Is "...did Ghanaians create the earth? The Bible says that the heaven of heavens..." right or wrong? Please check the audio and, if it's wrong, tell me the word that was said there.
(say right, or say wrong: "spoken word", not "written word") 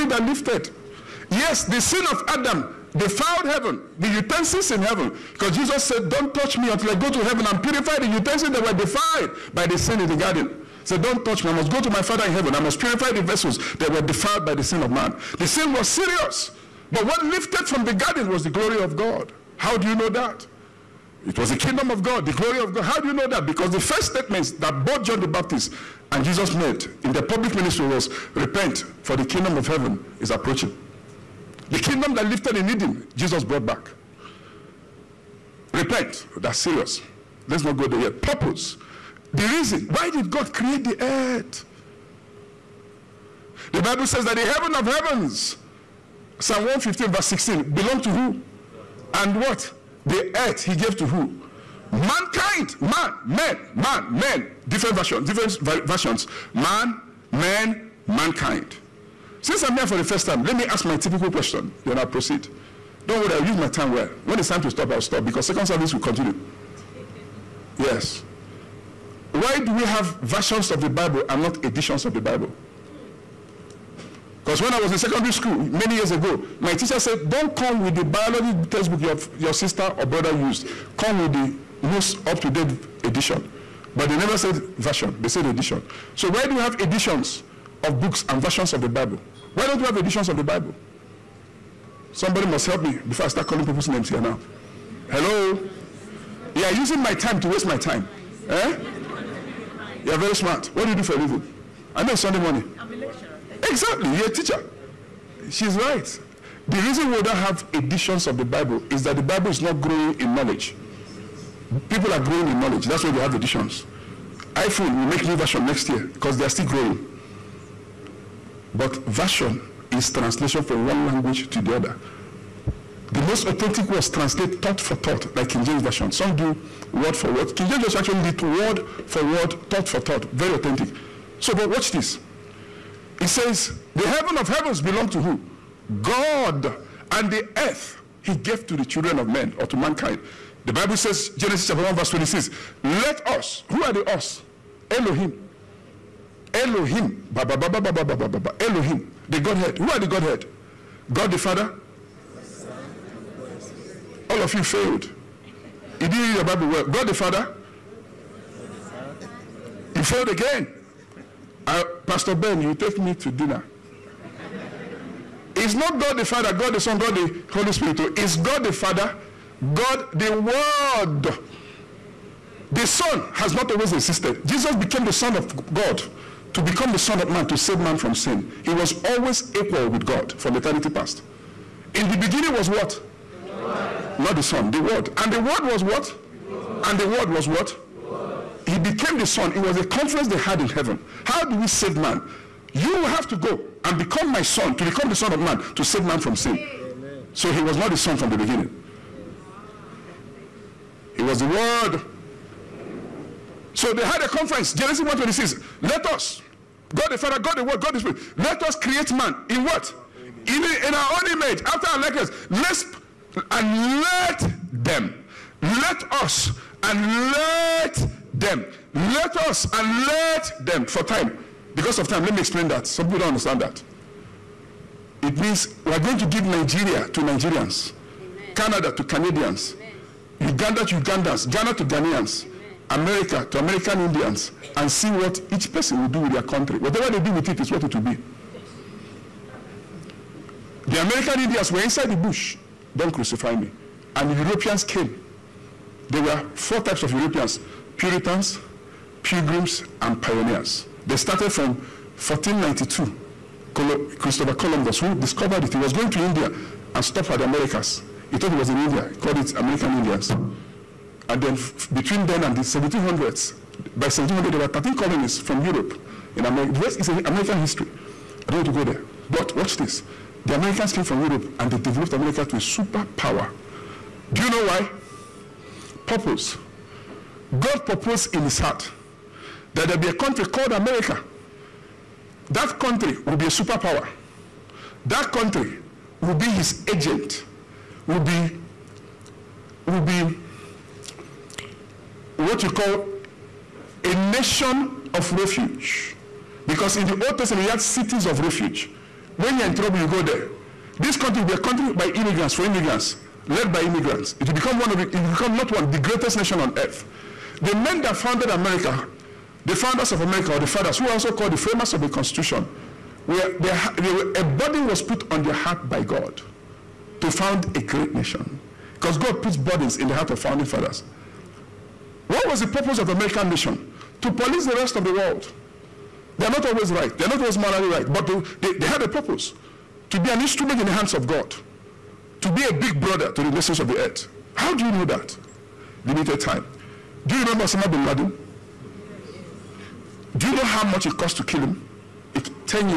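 wrong: "God", not "Ghanaians".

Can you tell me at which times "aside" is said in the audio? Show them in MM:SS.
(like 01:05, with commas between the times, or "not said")
not said.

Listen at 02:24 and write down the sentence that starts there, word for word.
Elohim Elohim, ba, ba, ba, ba, ba, ba, ba, ba, ba, Elohim, the Godhead.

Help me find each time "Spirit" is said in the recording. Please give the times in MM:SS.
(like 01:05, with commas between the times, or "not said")
02:47, 03:27.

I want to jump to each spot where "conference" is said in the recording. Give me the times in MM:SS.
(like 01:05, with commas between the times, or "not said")
03:09, 03:24.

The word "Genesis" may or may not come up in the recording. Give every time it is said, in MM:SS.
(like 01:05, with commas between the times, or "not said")
02:21, 03:24.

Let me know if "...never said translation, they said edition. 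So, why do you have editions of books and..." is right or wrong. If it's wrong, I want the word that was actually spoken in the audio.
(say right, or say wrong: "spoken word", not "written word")
wrong: "version", not "translation".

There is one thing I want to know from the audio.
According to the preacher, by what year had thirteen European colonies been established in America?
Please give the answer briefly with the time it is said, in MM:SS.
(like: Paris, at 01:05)
1700, at 04:23.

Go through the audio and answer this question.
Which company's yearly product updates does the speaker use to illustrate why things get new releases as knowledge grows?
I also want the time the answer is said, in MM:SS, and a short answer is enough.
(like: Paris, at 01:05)
iPhone, at 01:54.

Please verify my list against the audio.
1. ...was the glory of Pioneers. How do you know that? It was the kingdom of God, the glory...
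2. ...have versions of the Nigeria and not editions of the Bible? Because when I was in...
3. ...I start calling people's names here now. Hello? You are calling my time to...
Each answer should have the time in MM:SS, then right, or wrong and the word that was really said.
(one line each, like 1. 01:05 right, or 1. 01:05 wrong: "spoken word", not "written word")
1. 00:18 wrong: "God", not "Pioneers"
2. 01:09 wrong: "Bible", not "Nigeria"
3. 01:33 wrong: "using", not "calling".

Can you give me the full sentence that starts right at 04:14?
Christopher Columbus, who discovered it, he was going to India and stopped at the Americas.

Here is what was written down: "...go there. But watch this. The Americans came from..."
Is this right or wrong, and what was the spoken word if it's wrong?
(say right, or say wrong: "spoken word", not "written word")
right.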